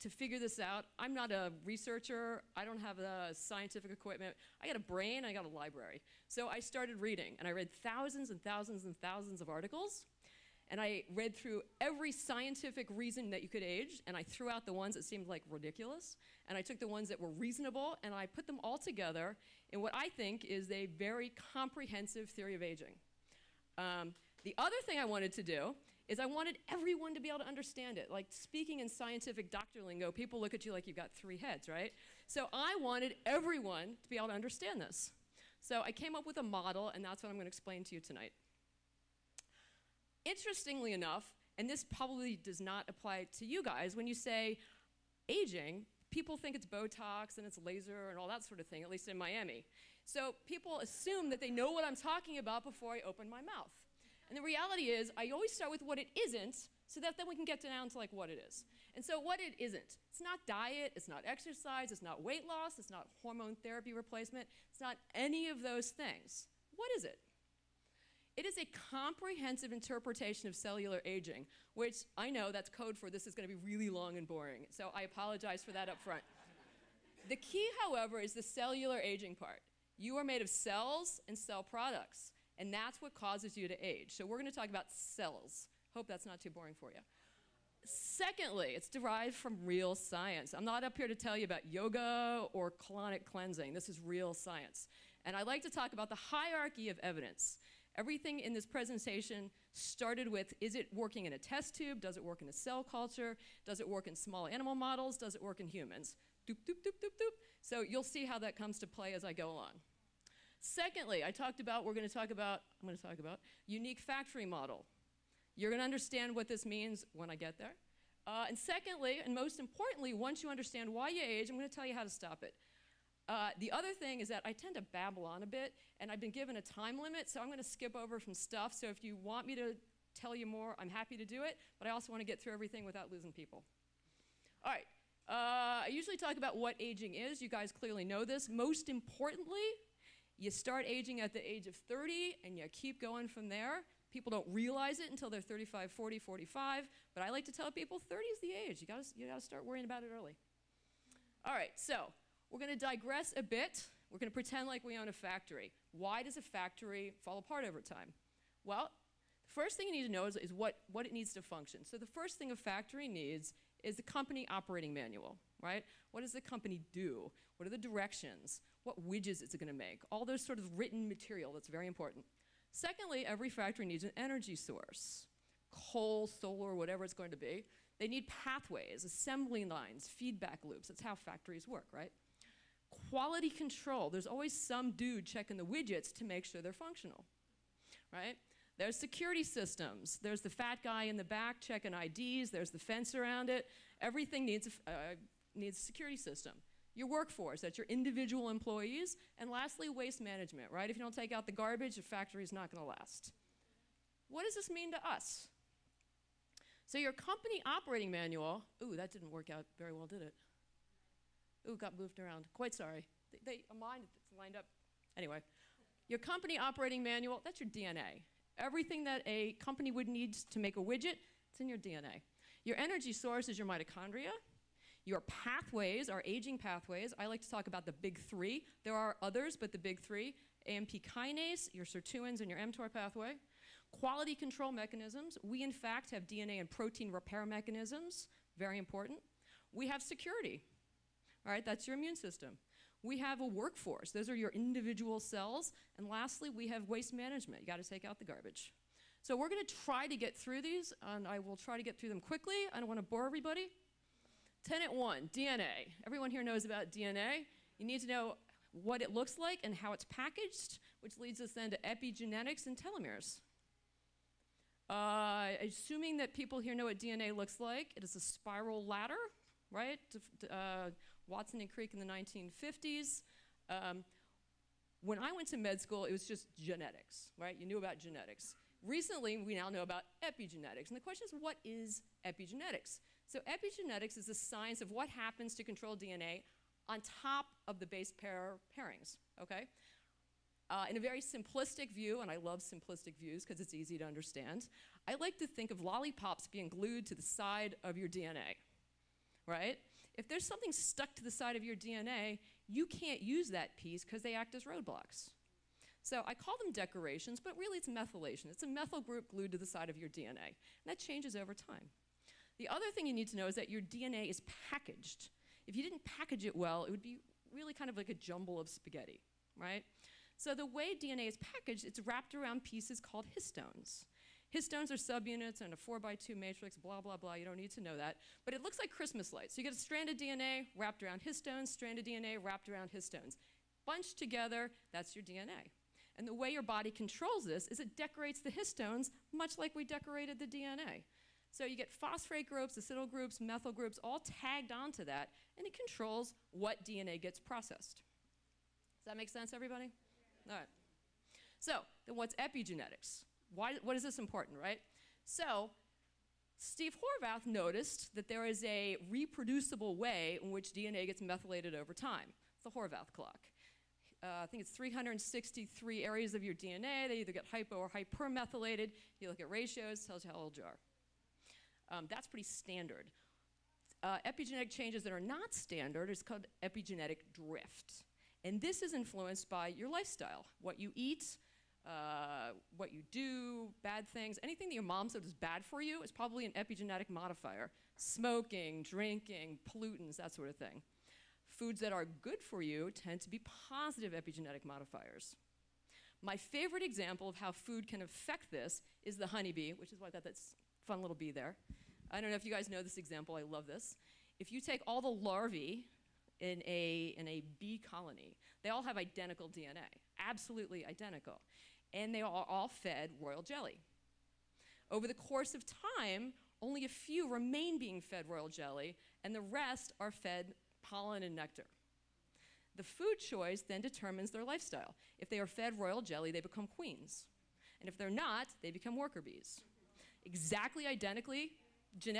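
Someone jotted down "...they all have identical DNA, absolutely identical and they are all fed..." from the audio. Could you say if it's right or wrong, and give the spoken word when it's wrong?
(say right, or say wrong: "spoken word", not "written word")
right.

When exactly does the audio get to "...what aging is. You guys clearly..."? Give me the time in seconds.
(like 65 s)
136 s.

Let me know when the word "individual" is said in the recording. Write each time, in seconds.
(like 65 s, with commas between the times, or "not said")
197 s, 244 s.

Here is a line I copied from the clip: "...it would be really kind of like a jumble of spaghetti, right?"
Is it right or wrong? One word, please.
right.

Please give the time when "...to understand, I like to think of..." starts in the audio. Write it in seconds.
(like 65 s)
293 s.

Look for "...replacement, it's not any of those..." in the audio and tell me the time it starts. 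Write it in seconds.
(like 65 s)
63 s.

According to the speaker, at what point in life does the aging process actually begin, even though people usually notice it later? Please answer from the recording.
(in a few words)
30.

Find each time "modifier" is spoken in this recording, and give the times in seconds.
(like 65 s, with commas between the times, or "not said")
387 s, 394 s.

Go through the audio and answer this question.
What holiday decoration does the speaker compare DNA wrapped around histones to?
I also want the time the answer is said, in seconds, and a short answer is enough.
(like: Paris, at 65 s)
Christmas lights, at 328 s.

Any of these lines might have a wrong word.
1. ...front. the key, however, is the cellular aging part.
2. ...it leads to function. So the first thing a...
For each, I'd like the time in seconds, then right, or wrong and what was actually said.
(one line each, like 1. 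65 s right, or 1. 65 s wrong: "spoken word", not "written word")
1. 75 s right
2. 161 s wrong: "needs", not "leads".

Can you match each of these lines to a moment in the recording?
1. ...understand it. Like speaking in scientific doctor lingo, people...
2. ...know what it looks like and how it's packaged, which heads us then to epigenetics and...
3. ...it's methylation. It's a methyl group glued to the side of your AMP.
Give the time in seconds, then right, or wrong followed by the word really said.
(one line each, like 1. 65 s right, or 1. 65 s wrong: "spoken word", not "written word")
1. 27 s right
2. 258 s wrong: "leads", not "heads"
3. 307 s wrong: "DNA", not "AMP".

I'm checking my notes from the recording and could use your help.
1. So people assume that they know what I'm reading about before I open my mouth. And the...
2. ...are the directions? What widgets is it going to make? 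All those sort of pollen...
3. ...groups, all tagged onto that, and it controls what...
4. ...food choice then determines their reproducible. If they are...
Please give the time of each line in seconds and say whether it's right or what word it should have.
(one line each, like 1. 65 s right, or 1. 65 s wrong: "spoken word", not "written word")
1. 50 s wrong: "talking", not "reading"
2. 167 s wrong: "written", not "pollen"
3. 343 s right
4. 422 s wrong: "lifestyle", not "reproducible".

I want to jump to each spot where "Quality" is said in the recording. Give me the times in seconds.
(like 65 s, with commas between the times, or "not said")
182 s, 233 s.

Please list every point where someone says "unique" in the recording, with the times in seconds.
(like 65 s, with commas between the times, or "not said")
113 s.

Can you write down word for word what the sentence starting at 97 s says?
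Everything in this presentation started with is it working in a test tube?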